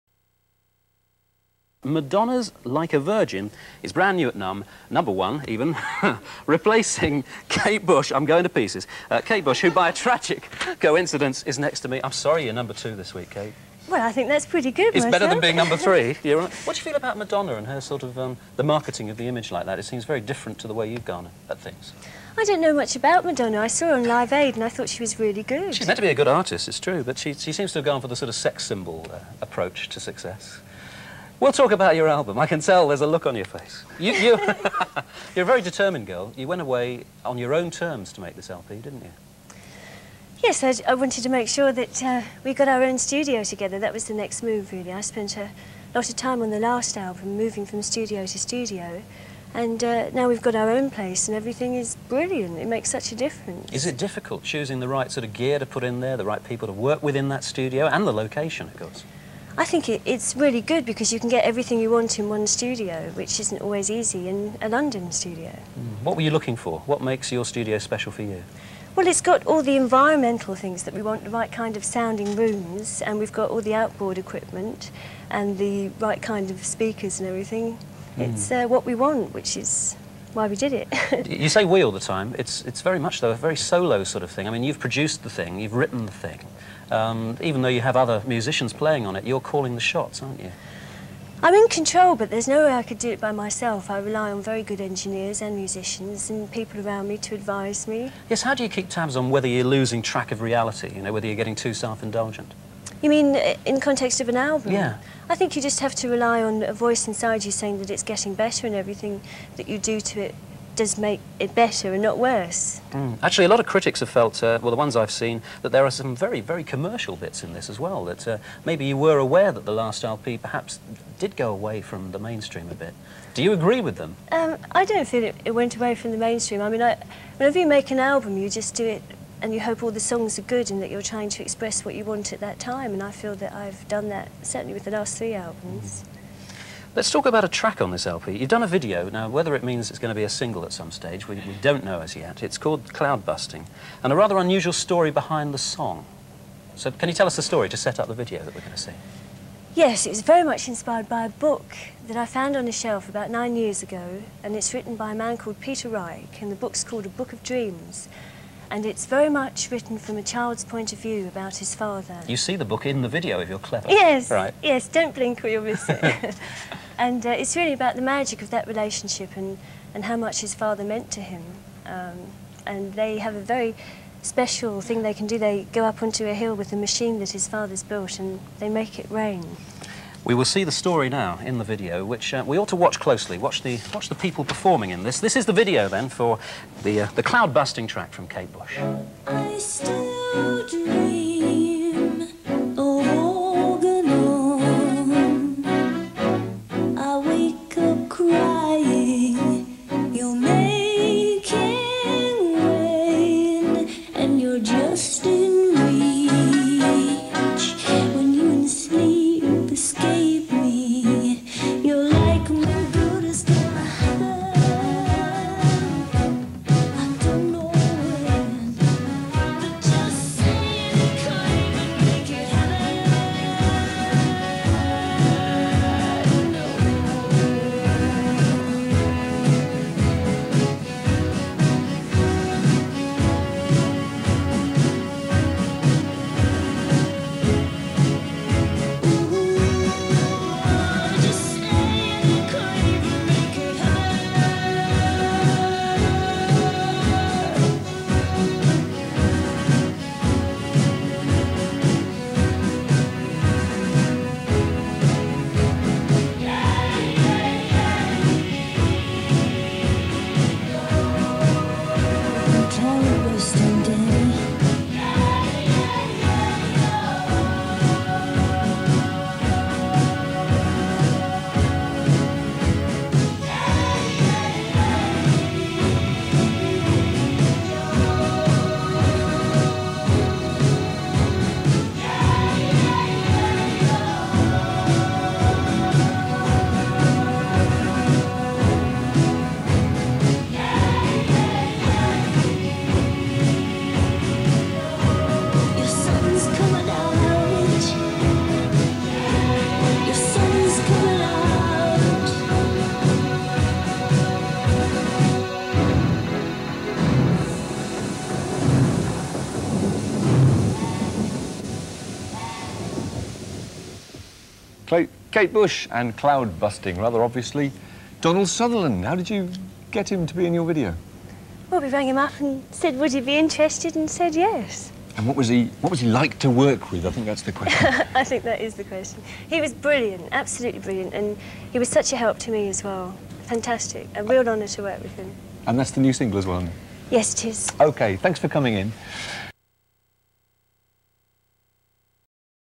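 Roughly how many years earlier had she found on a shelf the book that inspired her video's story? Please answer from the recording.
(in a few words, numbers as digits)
9.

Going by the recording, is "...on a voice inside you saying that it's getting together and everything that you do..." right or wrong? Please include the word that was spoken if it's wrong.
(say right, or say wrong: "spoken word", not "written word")
wrong: "better", not "together".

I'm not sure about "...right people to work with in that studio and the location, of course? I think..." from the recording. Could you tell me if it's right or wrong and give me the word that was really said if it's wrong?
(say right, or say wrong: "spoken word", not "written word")
right.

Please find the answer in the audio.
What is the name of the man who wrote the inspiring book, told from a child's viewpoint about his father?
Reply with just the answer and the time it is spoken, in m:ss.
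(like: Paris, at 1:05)
Peter Reich, at 2:35.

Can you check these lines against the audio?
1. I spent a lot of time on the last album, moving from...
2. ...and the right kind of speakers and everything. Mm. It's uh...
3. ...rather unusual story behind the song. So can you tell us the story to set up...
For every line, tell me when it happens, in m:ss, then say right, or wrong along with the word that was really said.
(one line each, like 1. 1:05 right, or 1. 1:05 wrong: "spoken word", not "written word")
1. 0:44 right
2. 1:15 right
3. 2:24 right.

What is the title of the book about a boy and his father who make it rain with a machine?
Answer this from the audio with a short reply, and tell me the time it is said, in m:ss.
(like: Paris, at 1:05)
A Book of Dreams, at 2:37.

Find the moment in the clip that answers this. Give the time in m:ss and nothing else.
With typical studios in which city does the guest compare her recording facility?
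1:04.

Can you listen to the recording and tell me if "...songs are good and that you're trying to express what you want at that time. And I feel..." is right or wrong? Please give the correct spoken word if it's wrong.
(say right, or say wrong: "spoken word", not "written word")
right.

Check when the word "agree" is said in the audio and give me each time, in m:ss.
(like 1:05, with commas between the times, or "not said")
2:03.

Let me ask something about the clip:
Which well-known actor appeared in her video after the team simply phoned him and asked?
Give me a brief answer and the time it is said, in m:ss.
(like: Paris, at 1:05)
Donald Sutherland, at 5:18.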